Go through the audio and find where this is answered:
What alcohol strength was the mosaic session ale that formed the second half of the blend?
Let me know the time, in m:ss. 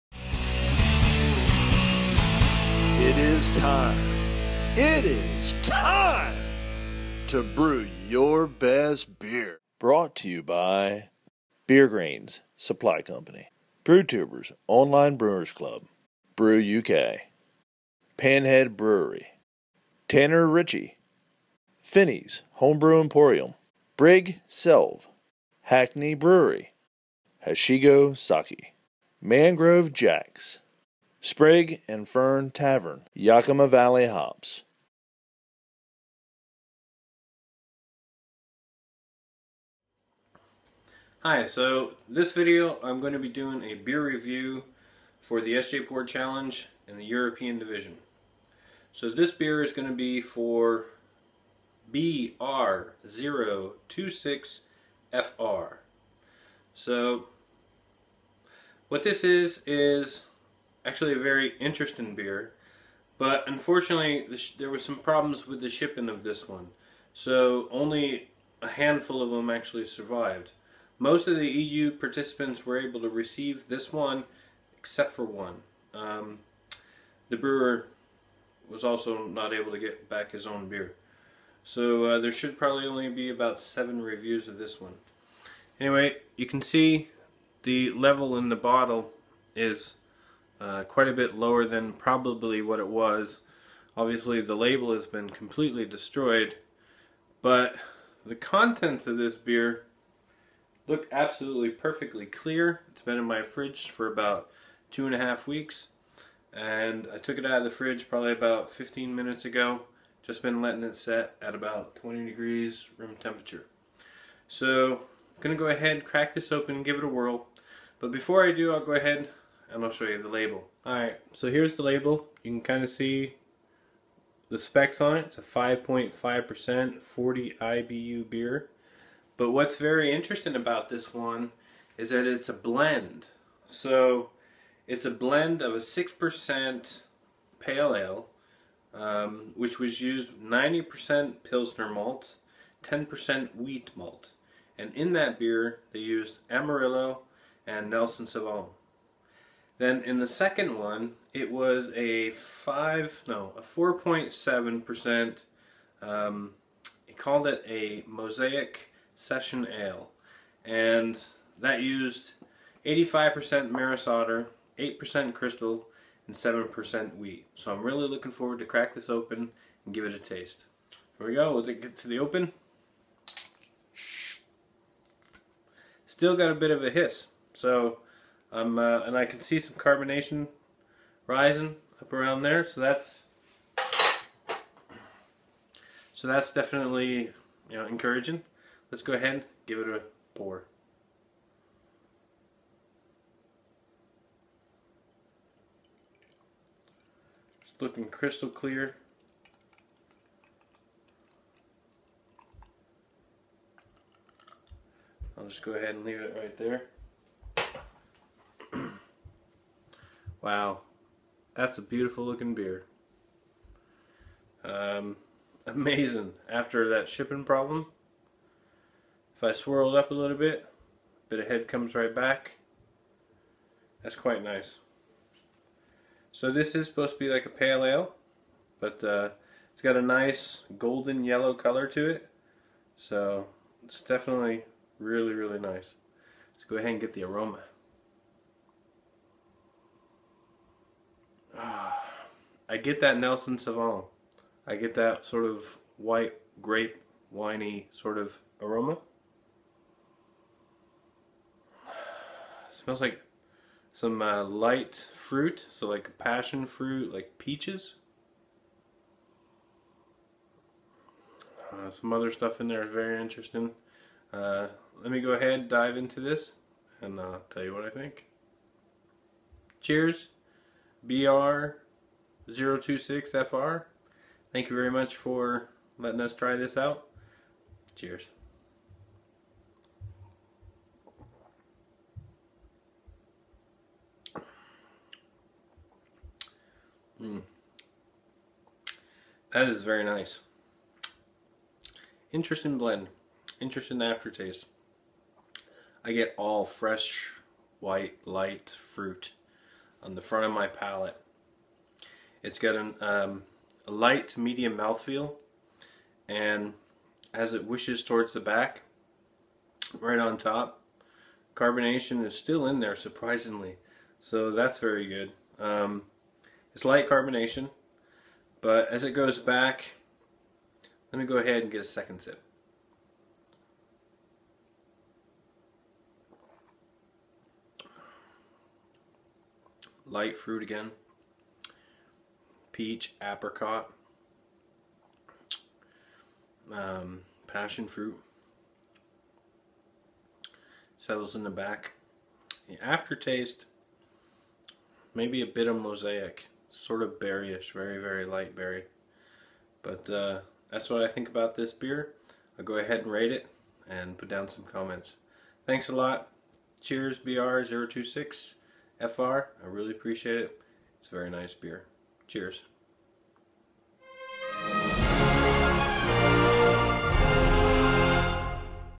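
2:33.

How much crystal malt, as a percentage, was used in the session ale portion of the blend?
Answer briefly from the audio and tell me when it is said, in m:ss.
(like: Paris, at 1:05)
8%, at 2:44.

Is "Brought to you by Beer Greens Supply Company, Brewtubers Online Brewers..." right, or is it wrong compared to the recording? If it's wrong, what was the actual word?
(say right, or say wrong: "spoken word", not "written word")
right.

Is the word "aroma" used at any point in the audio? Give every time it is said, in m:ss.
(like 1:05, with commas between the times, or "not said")
3:57, 4:08.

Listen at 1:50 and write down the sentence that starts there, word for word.
Just been letting it set at about 20 degrees room temperature.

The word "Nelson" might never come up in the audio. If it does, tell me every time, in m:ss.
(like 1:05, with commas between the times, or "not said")
2:27, 4:03.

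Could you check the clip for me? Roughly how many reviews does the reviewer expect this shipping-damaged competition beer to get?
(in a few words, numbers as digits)
7.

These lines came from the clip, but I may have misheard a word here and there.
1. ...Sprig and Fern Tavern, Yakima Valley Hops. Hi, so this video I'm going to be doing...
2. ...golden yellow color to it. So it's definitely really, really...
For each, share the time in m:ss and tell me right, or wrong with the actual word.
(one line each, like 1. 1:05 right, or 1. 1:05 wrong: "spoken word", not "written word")
1. 0:31 right
2. 3:50 right.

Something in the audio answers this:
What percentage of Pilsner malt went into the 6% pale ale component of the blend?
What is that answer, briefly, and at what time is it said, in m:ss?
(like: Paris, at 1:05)
90%, at 2:20.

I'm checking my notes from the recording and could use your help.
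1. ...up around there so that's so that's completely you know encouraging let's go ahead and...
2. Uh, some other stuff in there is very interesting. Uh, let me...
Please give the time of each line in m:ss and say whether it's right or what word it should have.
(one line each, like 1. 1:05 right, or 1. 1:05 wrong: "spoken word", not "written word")
1. 3:02 wrong: "definitely", not "completely"
2. 4:21 right.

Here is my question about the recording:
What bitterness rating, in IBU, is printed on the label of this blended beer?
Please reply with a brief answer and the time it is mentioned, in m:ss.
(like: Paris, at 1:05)
40, at 2:07.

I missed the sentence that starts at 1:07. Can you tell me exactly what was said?
So only a handful of them actually survived.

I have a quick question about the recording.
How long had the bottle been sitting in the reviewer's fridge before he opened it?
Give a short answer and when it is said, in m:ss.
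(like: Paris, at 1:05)
2.5 weeks, at 1:44.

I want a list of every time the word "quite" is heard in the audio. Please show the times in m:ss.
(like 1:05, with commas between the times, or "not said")
1:30, 3:44.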